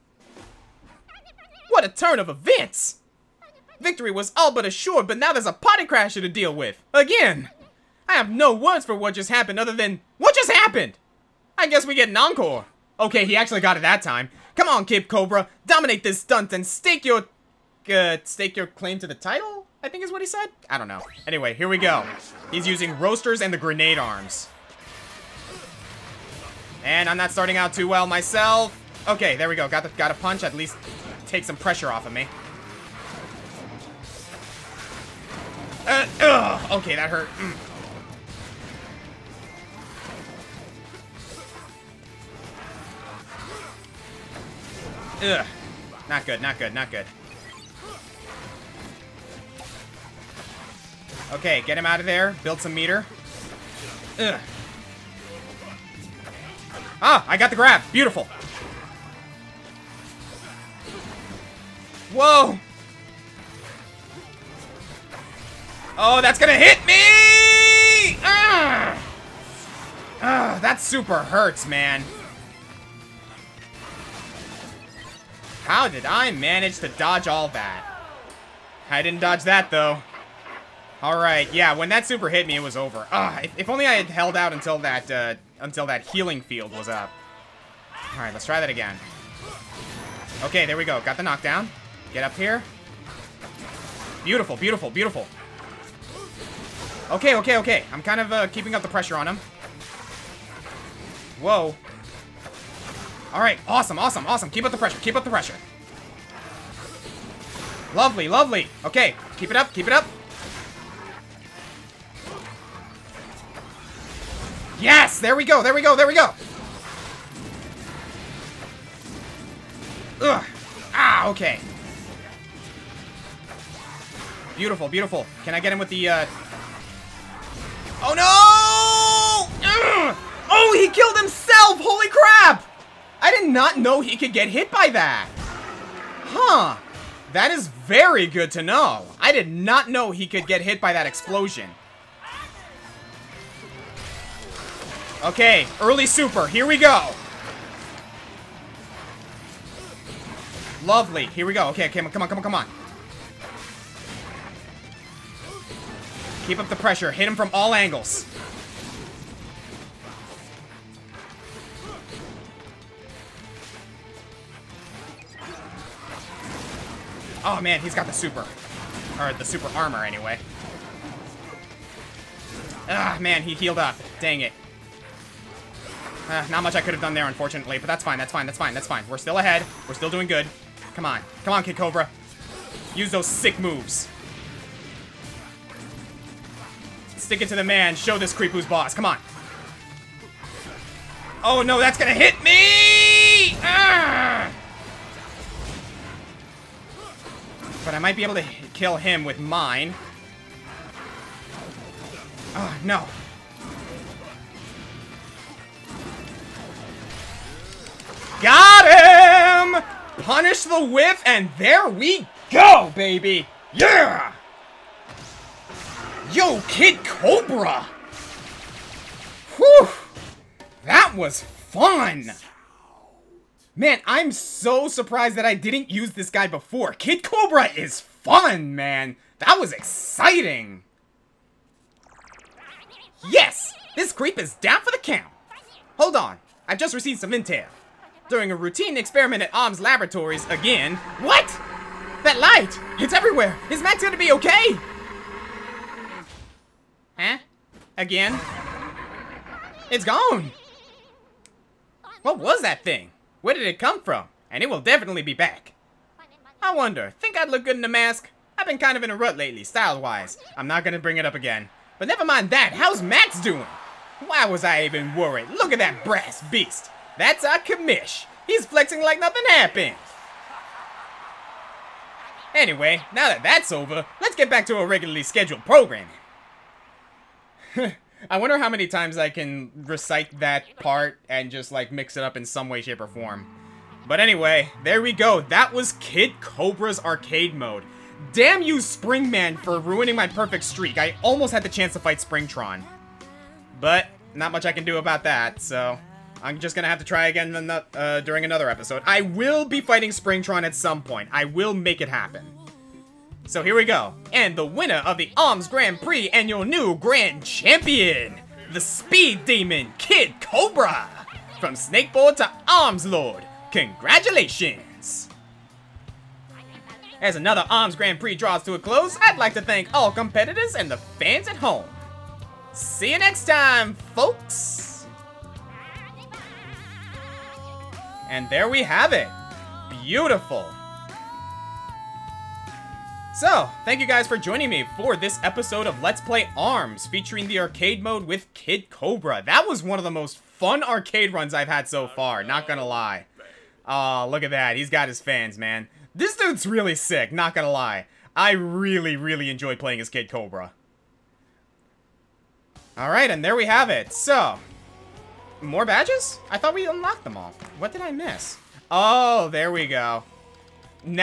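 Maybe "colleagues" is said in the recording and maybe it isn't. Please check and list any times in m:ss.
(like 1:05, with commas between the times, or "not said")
not said.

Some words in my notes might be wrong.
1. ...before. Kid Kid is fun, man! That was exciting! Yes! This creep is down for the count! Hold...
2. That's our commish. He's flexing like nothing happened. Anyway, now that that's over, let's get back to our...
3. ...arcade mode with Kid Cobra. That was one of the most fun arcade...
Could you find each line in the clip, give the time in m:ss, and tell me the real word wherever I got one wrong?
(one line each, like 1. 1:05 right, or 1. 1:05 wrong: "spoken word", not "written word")
1. 3:46 wrong: "Cobra", not "Kid"
2. 4:27 right
3. 5:37 right.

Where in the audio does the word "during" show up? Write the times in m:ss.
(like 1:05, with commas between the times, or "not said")
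3:58, 4:58.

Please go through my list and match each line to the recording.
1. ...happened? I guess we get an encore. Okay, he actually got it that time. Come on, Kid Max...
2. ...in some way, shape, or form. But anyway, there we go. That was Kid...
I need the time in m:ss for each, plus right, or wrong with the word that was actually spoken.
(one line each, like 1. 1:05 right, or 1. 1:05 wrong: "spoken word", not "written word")
1. 0:10 wrong: "Cobra", not "Max"
2. 4:42 right.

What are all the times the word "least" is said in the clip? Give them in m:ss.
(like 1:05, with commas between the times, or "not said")
0:30.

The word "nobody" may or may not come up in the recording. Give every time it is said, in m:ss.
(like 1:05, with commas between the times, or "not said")
not said.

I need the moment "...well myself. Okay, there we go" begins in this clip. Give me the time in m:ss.
0:27.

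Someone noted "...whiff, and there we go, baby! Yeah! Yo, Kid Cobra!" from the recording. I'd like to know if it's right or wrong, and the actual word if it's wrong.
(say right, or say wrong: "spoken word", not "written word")
right.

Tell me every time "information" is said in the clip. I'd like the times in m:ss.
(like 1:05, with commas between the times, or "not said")
not said.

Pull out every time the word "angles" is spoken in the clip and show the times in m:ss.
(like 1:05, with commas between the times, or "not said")
2:37.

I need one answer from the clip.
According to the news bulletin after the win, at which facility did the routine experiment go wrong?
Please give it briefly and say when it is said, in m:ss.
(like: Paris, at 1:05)
Arms Laboratories, at 3:59.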